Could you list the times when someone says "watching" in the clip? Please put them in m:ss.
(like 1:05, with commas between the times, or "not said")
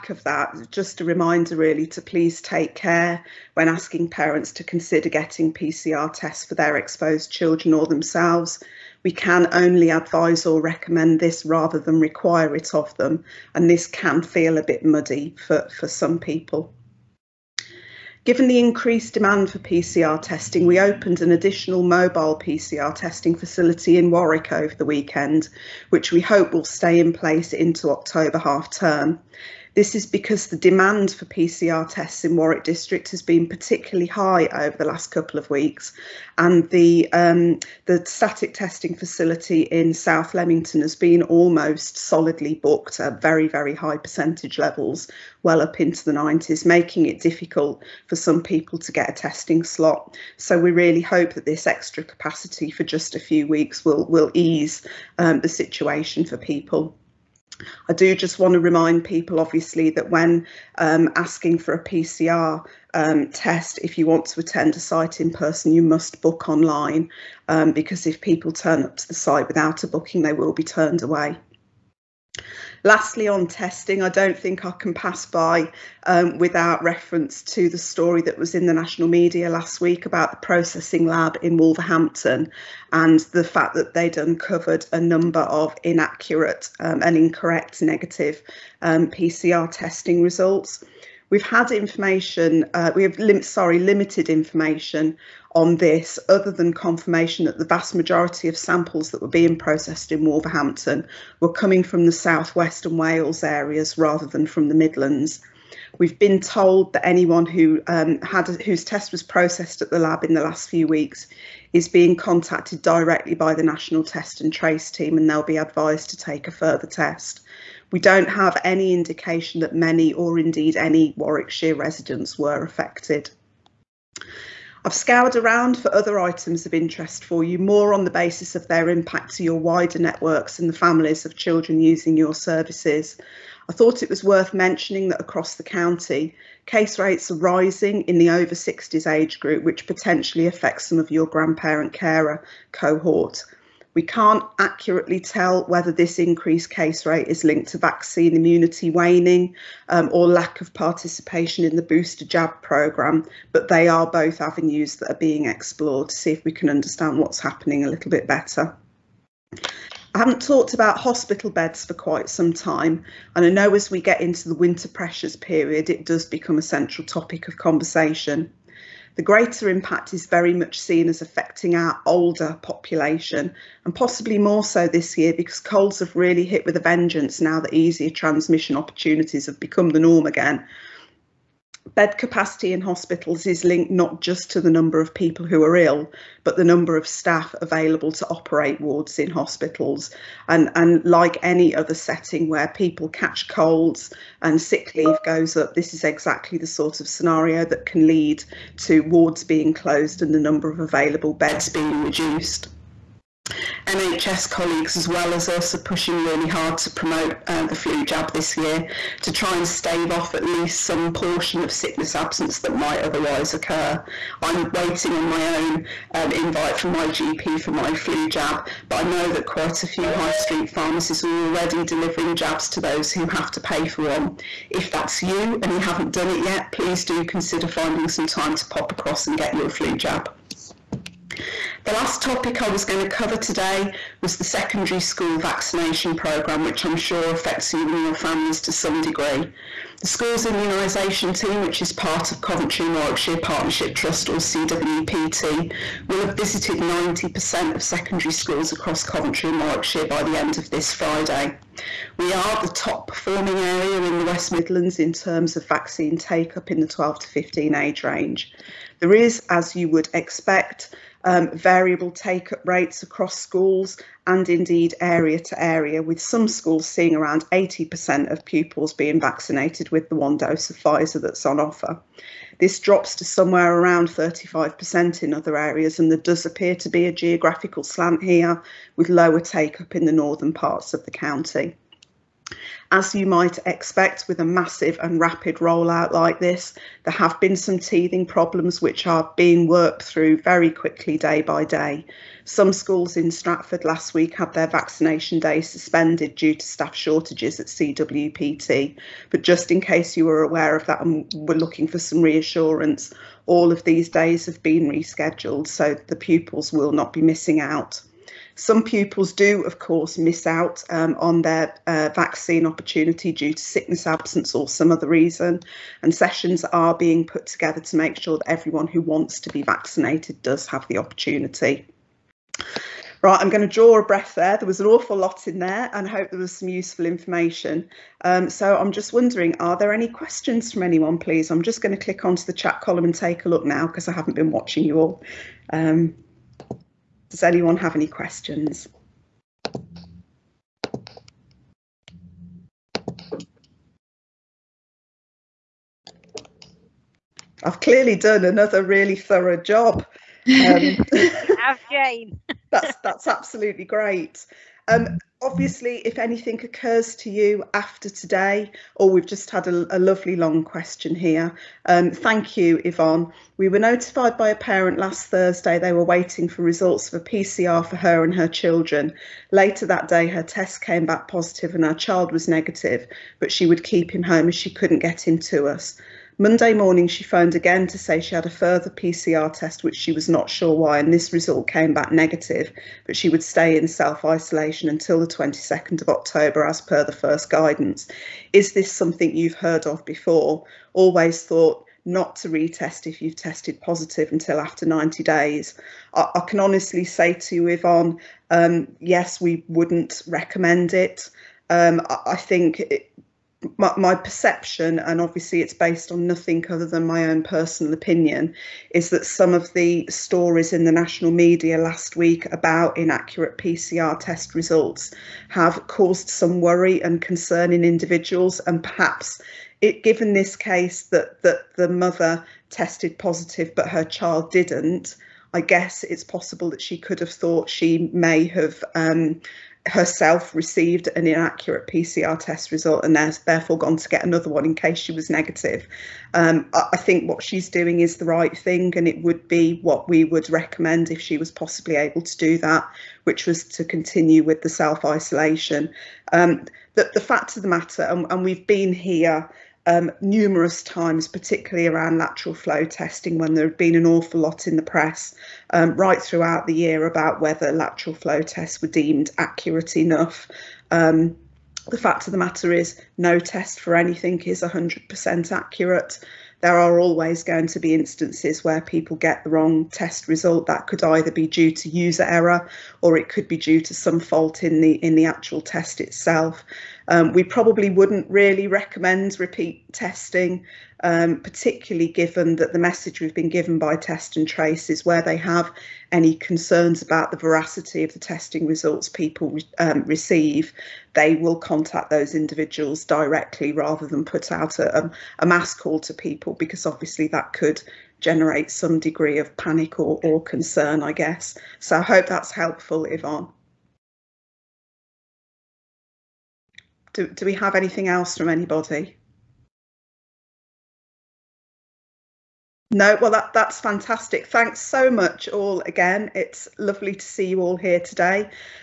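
5:34.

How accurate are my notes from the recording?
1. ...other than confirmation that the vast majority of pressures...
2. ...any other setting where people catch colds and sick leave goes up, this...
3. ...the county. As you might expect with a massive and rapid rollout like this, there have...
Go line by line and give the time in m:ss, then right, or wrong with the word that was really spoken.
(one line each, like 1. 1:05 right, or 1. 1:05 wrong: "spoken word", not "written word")
1. 1:36 wrong: "samples", not "pressures"
2. 3:11 right
3. 4:41 right.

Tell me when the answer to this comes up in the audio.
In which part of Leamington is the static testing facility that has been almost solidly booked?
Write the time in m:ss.
0:39.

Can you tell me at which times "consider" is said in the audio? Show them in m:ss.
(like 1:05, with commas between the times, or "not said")
0:04, 3:47.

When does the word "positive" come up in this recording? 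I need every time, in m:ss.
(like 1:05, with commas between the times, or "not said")
6:11, 6:33, 7:03.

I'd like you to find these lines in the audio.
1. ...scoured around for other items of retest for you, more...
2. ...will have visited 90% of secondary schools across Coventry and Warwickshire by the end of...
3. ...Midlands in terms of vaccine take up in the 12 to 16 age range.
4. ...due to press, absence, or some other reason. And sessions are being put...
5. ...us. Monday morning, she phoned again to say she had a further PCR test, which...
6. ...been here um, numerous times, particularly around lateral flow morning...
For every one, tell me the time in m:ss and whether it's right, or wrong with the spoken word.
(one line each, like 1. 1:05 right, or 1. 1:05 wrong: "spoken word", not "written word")
1. 2:04 wrong: "interest", not "retest"
2. 4:06 right
3. 4:14 wrong: "15", not "16"
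4. 5:13 wrong: "sickness", not "press"
5. 6:15 right
6. 7:28 wrong: "testing", not "morning".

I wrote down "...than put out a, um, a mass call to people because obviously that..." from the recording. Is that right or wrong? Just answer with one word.
right.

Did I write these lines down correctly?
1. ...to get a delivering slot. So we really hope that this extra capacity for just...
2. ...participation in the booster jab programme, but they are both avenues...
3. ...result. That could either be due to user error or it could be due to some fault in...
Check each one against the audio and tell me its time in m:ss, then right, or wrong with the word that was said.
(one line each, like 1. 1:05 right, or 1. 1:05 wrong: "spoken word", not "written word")
1. 0:48 wrong: "testing", not "delivering"
2. 2:30 right
3. 7:50 right.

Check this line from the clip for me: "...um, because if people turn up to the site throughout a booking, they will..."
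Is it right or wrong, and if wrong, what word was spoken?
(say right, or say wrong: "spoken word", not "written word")
wrong: "without", not "throughout".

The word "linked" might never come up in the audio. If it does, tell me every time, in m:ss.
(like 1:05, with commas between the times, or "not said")
2:27, 3:03.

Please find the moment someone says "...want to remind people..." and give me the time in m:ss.
0:58.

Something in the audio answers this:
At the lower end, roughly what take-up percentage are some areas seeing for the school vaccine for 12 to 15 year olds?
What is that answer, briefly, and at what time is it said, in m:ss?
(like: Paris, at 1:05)
35%, at 4:34.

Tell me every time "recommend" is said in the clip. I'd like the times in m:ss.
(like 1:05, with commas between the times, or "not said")
0:10, 6:40, 7:20, 7:58.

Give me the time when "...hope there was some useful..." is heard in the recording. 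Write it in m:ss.
5:26.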